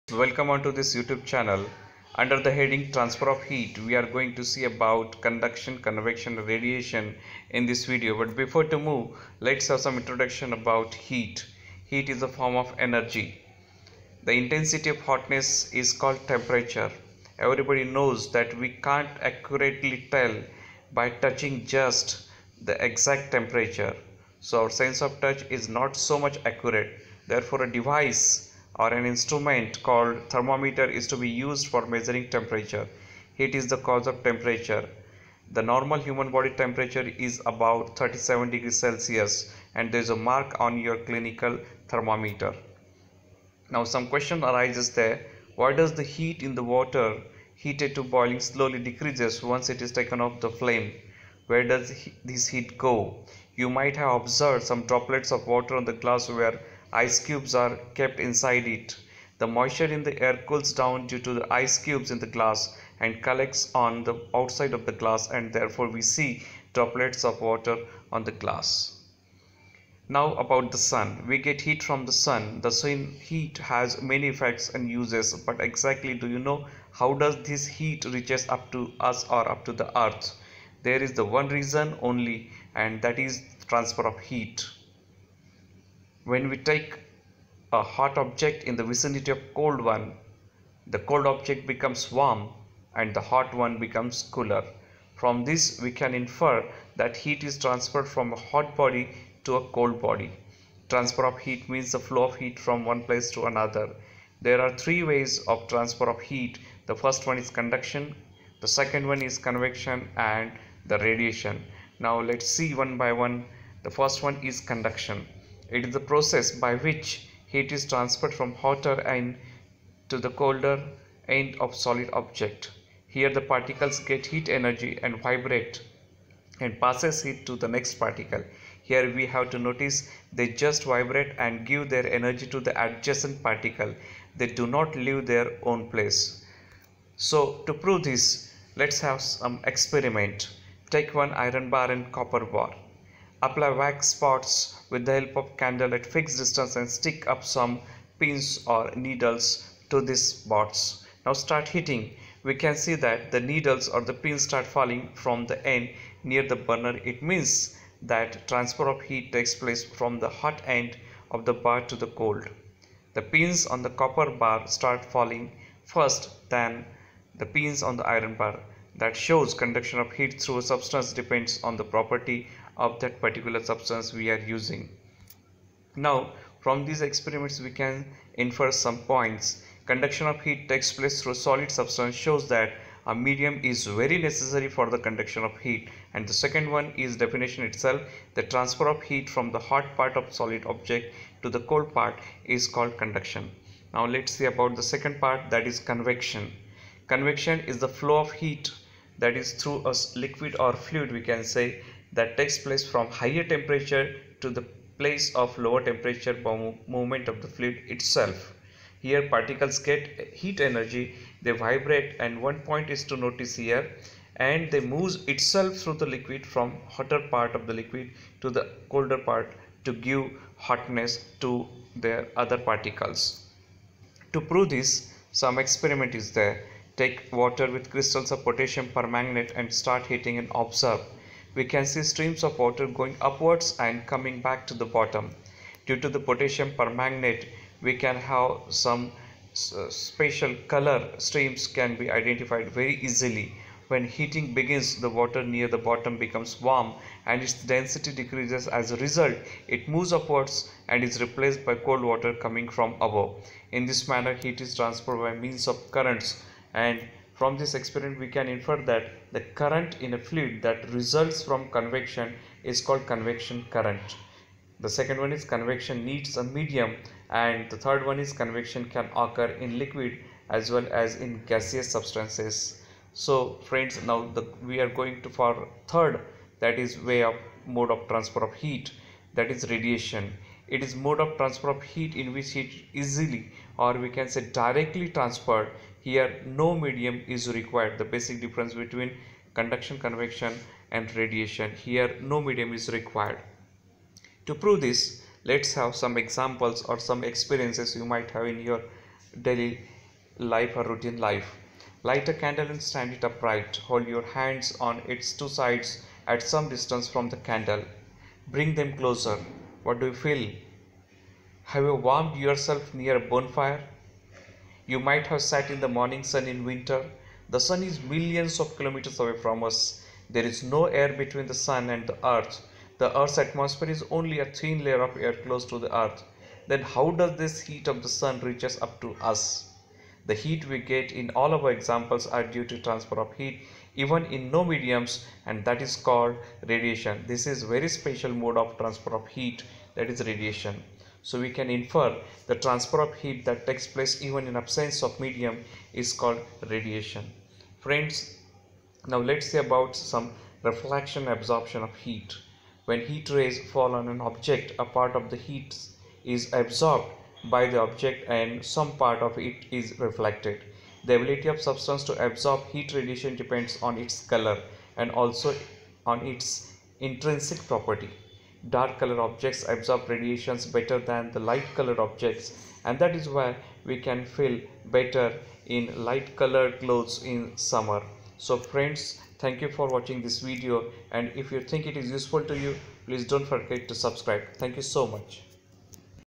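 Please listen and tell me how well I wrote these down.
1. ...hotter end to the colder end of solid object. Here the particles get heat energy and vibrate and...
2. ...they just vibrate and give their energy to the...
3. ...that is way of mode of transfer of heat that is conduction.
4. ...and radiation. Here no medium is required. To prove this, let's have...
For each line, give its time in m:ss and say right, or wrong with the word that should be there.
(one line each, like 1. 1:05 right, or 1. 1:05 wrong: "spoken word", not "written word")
1. 1:58 right
2. 2:10 right
3. 4:36 wrong: "radiation", not "conduction"
4. 4:50 right.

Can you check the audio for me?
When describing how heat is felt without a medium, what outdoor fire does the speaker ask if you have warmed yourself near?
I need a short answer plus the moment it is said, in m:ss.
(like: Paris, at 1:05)
A bonfire, at 5:13.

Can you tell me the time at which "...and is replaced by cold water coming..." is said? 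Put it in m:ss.
4:10.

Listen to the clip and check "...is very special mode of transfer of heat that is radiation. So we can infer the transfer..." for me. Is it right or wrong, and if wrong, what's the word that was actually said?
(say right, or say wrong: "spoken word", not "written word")
right.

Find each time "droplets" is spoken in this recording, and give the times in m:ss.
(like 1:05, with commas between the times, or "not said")
0:54, 1:06.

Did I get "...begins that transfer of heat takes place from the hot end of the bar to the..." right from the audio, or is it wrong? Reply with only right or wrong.
wrong.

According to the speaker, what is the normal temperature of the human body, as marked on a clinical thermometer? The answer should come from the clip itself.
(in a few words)
37 degrees Celsius.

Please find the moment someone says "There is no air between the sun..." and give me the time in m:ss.
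5:20.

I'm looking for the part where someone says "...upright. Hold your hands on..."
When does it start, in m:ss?
5:03.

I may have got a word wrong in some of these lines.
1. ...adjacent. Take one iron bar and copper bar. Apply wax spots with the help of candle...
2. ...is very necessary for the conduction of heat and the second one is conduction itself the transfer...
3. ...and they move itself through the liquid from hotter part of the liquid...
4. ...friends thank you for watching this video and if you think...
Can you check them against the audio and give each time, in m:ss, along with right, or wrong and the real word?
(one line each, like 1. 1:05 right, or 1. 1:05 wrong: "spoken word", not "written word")
1. 2:19 wrong: "experiment", not "adjacent"
2. 3:03 wrong: "definition", not "conduction"
3. 3:34 right
4. 6:18 right.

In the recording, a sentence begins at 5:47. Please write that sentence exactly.
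Friends, now let's say about some reflection absorption of heat.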